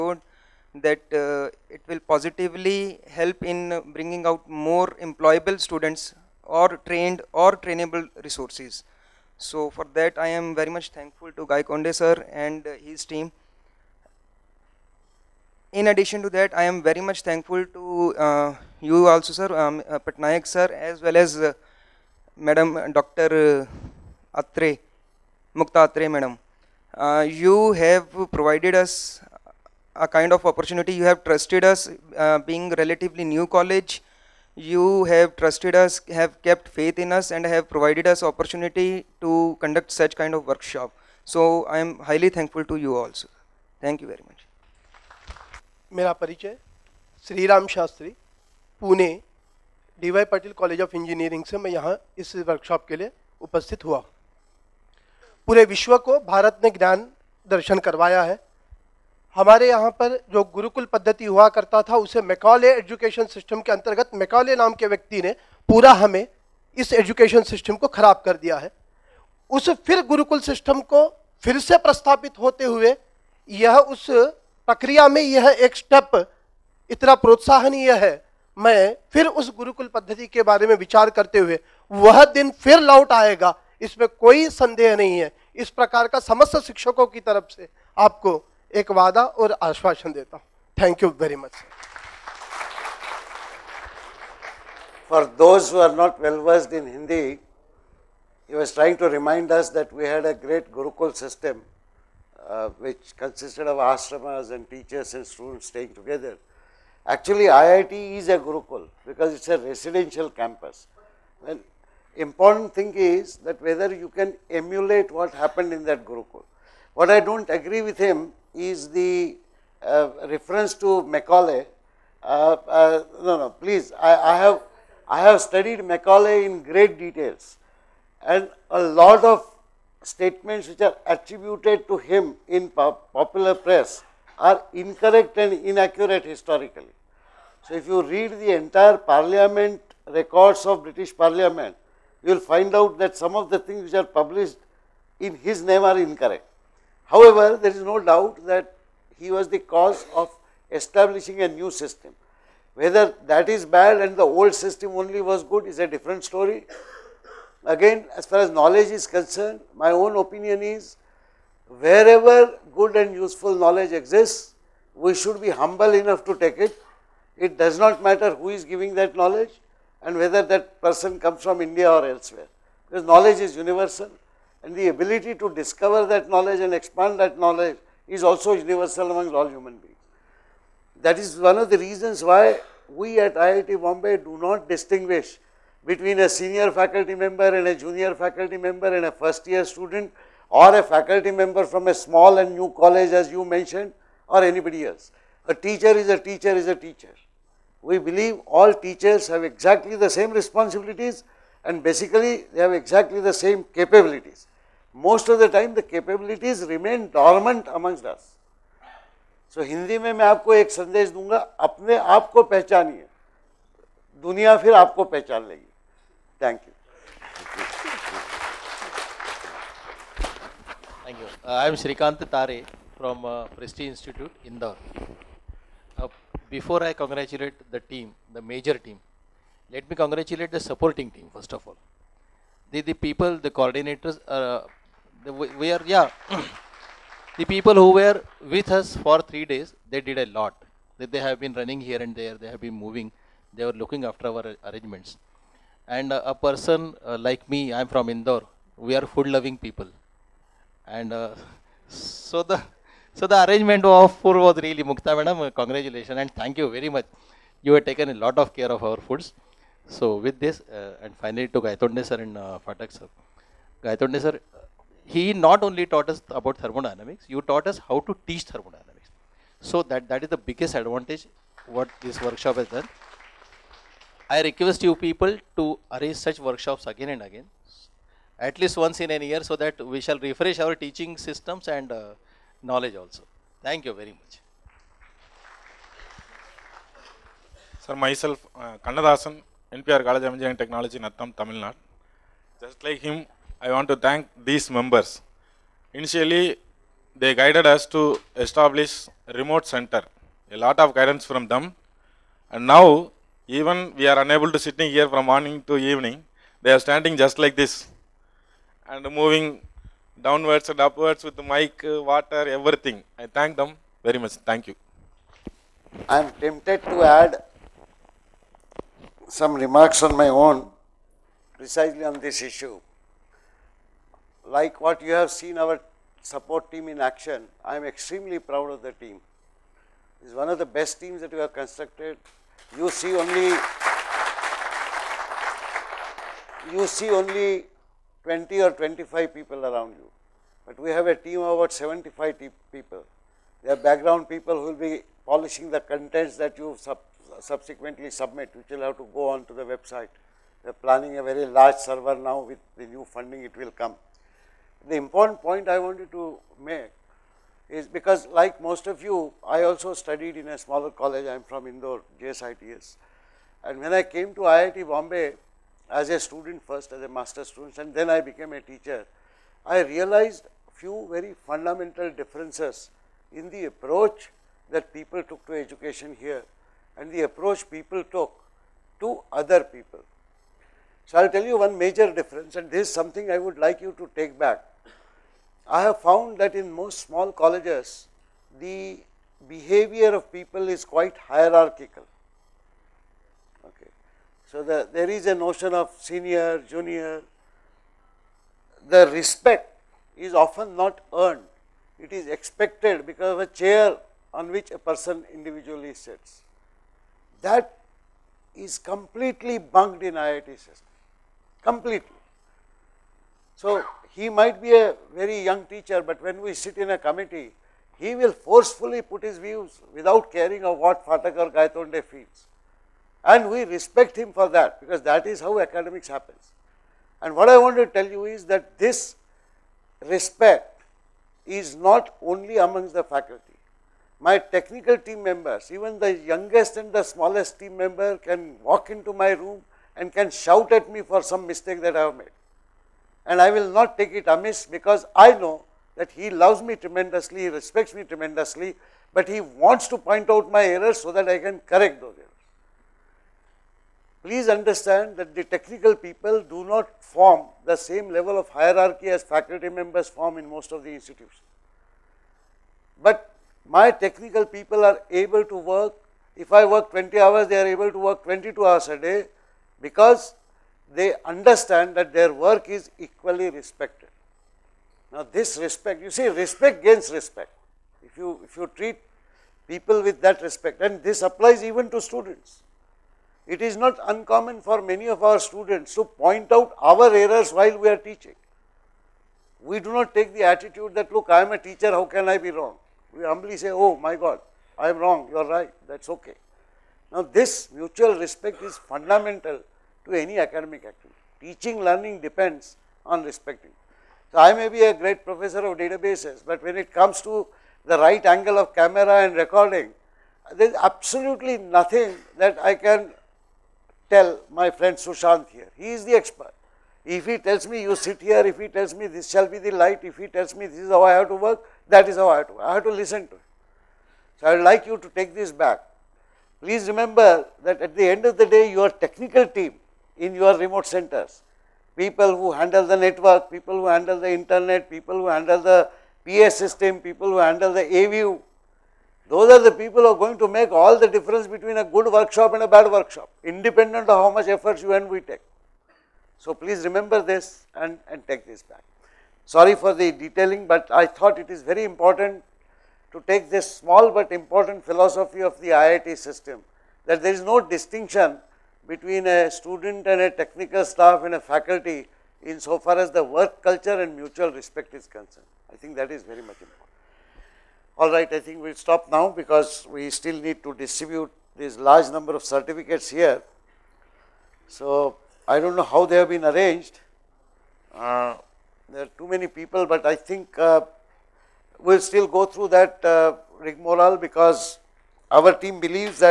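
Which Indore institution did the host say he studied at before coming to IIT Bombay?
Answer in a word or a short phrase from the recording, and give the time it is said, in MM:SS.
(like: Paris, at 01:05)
JSITS, at 06:02.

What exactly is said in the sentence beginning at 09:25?
I think that is very much important.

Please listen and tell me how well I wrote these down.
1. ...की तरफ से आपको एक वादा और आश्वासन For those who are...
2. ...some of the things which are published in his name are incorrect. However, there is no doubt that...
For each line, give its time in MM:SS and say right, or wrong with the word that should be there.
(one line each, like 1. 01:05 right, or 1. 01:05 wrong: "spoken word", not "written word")
1. 01:27 right
2. 02:23 right.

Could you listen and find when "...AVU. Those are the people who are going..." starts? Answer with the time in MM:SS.
08:57.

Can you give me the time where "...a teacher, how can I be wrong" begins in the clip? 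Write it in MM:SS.
08:11.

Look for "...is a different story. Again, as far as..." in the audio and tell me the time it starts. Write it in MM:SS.
02:35.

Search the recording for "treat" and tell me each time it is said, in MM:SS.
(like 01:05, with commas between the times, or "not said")
07:58.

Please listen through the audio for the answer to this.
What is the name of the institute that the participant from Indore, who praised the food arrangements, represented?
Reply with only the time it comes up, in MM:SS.
03:43.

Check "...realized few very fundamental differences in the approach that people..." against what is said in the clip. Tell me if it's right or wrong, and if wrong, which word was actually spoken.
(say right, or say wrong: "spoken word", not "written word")
right.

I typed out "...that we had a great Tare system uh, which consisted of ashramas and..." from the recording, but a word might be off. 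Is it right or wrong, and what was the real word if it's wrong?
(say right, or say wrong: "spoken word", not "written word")
wrong: "Gurukul", not "Tare".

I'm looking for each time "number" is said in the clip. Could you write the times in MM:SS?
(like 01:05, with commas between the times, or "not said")
09:32.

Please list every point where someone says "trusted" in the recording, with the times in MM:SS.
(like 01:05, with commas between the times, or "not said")
00:31, 00:35.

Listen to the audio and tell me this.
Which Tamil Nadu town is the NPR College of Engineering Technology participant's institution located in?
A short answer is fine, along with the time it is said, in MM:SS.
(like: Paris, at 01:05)
Nattam, at 04:50.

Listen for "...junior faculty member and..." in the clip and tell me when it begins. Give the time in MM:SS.
03:07.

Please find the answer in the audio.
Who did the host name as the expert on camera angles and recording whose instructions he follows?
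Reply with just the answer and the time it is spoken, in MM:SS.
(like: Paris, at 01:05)
Sushant, at 08:34.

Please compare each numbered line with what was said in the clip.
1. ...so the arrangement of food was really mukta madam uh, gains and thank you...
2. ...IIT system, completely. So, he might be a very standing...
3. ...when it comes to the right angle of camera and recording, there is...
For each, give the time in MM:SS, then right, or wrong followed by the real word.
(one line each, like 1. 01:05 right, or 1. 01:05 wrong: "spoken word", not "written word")
1. 04:13 wrong: "congratulations", not "gains"
2. 06:50 wrong: "young", not "standing"
3. 08:26 right.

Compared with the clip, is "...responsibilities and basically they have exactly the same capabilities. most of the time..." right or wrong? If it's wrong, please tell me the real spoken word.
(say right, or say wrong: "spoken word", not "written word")
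right.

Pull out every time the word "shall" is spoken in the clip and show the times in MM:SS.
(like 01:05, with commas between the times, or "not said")
04:40, 08:39.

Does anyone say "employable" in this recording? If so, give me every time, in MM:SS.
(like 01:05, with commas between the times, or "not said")
00:05.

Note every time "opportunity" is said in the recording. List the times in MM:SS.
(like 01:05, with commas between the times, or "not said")
00:30, 00:38.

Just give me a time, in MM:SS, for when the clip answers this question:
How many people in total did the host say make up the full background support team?
05:41.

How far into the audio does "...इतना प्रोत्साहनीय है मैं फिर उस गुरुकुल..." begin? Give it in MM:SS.
01:16.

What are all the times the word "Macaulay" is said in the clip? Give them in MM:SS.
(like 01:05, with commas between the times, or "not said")
02:01, 02:05.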